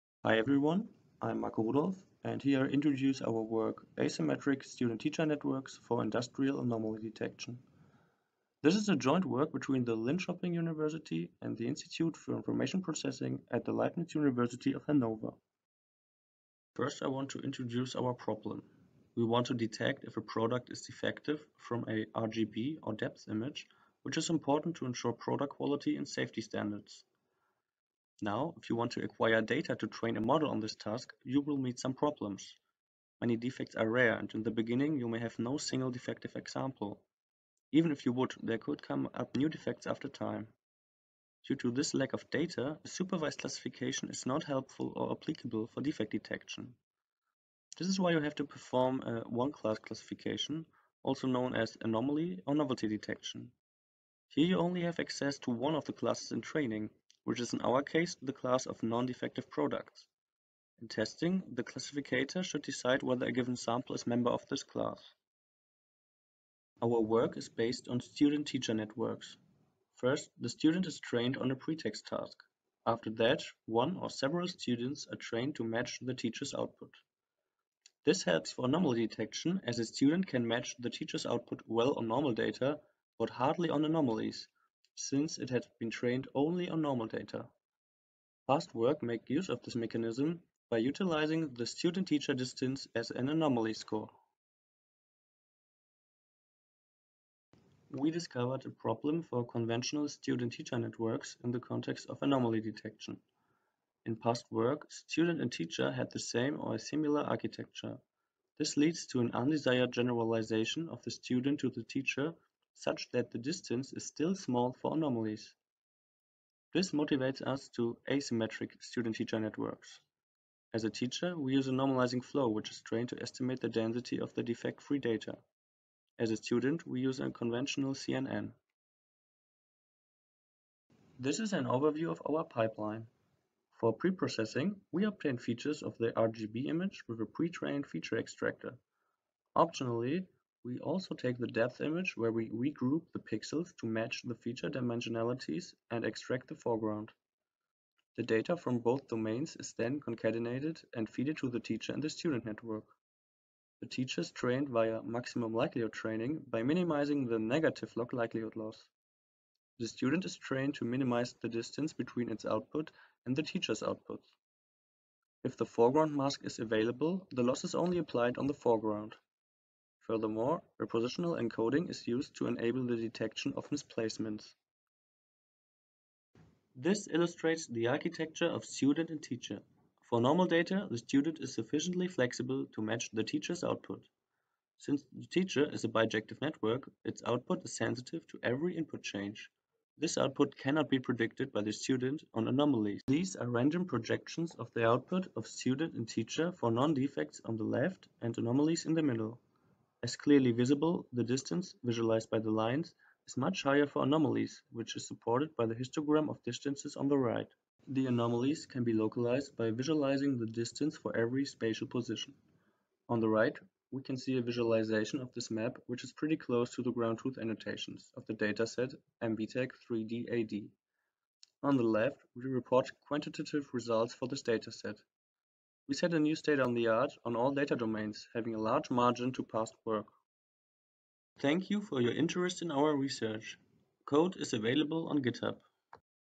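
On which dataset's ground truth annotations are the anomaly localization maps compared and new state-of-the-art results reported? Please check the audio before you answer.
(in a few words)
MVTec 3D-AD.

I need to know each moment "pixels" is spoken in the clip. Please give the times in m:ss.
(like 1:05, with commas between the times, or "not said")
2:23.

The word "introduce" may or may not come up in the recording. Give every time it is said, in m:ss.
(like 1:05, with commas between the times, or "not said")
0:02, 0:17.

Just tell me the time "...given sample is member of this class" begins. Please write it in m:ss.
1:03.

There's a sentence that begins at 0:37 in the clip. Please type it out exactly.
Even if you would, there could come up new defects after time.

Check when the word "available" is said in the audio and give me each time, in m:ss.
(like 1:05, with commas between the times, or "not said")
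2:46, 3:54.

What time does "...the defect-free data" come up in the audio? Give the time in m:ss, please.
2:04.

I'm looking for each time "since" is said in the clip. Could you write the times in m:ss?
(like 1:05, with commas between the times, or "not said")
1:25, 3:04.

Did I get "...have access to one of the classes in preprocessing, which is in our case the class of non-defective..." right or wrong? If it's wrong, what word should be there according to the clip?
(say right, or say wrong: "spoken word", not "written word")
wrong: "training", not "preprocessing".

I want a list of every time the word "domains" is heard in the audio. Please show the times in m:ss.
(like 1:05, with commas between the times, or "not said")
2:29, 3:47.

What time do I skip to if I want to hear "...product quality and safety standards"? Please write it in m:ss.
0:25.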